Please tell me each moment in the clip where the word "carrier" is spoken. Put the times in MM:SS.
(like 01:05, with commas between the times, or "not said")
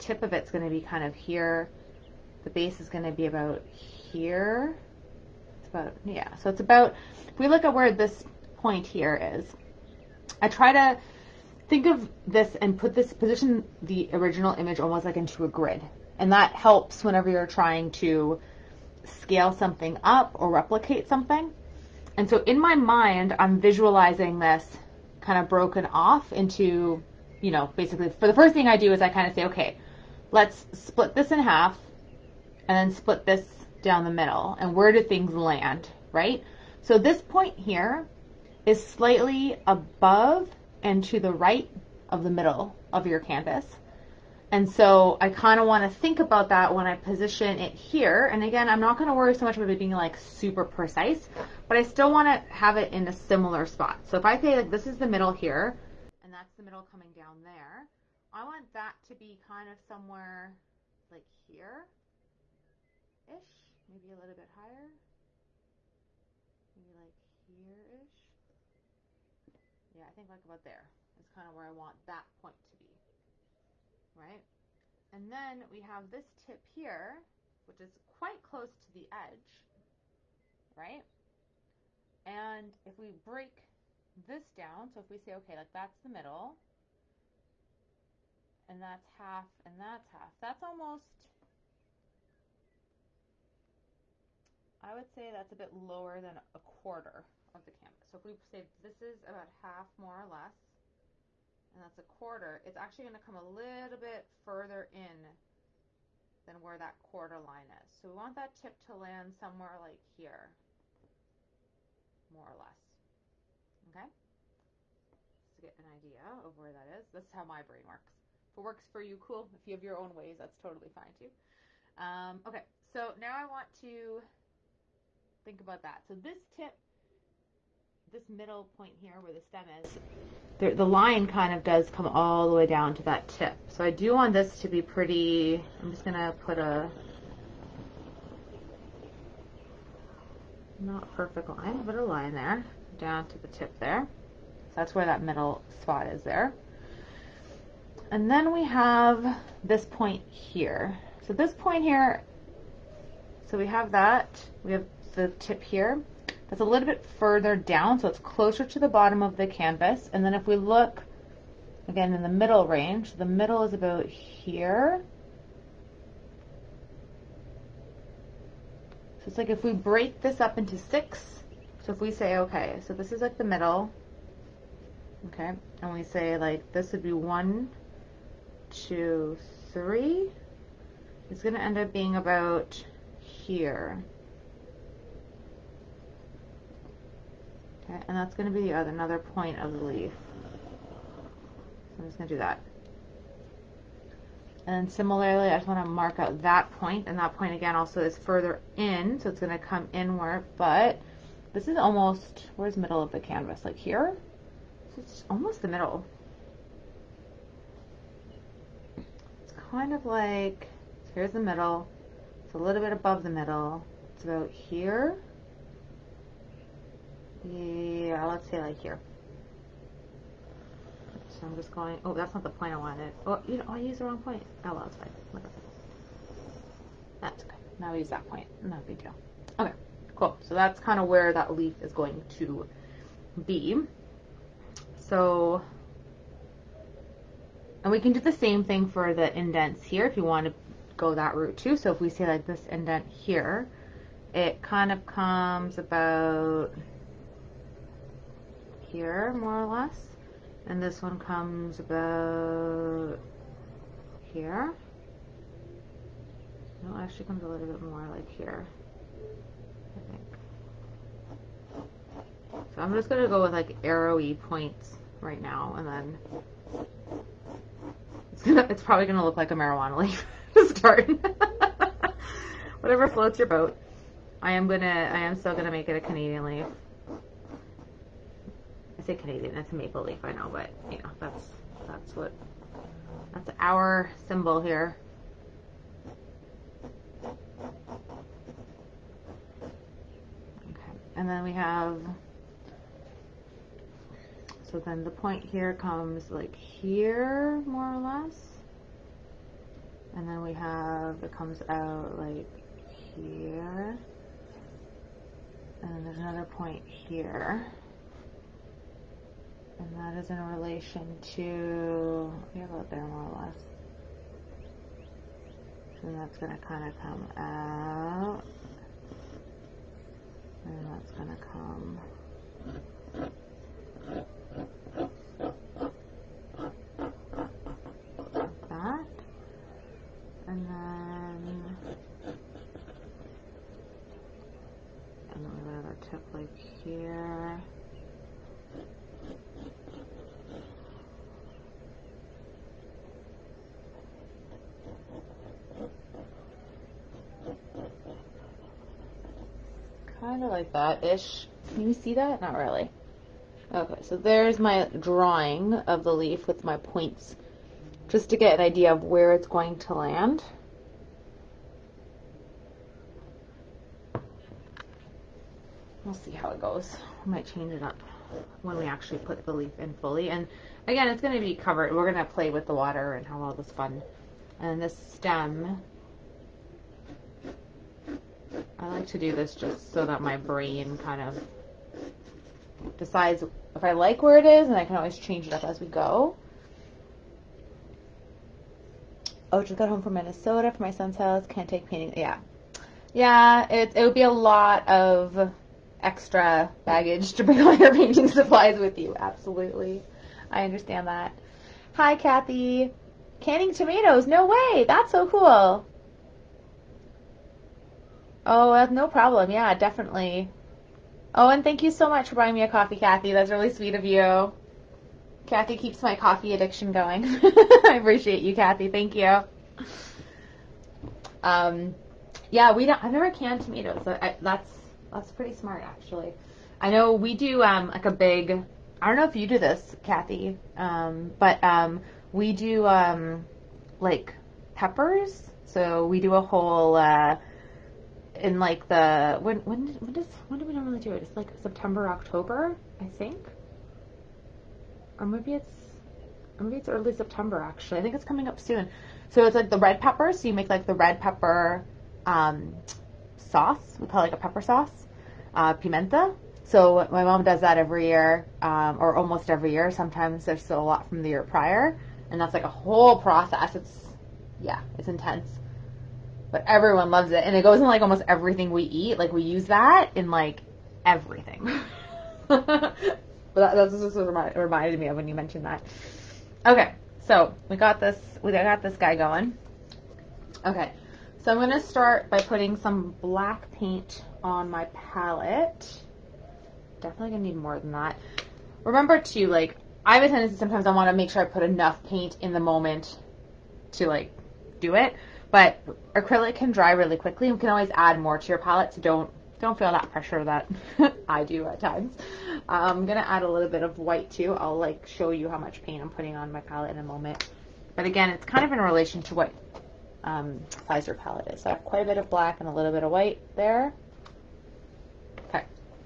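not said.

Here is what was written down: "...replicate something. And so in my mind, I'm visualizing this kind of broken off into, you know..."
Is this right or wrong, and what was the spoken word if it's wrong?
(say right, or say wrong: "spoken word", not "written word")
right.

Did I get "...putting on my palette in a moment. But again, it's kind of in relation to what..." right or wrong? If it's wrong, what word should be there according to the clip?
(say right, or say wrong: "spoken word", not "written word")
right.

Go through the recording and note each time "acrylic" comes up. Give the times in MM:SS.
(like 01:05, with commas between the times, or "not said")
08:16.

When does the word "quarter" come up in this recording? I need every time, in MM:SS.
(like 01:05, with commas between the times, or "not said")
01:36, 01:42, 01:46.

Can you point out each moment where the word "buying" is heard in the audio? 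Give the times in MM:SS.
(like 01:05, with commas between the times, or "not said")
06:52.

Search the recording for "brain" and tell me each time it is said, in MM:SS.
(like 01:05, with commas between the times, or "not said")
01:57, 06:20.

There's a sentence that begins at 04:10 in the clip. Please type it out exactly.
And this one comes about here.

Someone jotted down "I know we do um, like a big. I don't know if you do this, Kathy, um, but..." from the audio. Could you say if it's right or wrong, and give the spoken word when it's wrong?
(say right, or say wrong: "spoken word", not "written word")
right.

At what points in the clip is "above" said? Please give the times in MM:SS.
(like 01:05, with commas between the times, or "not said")
00:39, 03:32.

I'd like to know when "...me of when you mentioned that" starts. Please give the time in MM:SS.
07:54.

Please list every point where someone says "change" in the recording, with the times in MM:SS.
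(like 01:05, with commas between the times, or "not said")
06:07, 06:25.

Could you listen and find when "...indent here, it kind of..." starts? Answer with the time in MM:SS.
04:02.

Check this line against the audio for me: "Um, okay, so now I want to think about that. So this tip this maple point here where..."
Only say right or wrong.
wrong.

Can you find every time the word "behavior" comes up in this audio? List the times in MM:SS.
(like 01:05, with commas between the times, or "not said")
not said.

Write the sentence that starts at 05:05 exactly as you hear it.
And then there's another point here.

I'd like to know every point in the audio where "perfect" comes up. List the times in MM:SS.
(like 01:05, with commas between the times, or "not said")
02:21.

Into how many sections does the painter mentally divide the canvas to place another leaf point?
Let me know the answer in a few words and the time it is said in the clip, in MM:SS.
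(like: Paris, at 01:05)
6, at 02:50.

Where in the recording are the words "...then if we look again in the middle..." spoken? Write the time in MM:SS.
02:40.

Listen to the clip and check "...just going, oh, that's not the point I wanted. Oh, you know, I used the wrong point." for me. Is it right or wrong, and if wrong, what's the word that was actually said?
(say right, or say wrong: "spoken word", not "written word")
right.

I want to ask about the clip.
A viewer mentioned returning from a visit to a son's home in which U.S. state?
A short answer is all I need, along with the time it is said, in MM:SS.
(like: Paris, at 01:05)
Minnesota, at 06:30.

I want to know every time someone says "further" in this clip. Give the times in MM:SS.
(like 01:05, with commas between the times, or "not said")
01:44, 02:37, 03:18.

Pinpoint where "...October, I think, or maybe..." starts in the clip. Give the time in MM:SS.
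07:22.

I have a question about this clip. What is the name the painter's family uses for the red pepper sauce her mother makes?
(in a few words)
pimenta.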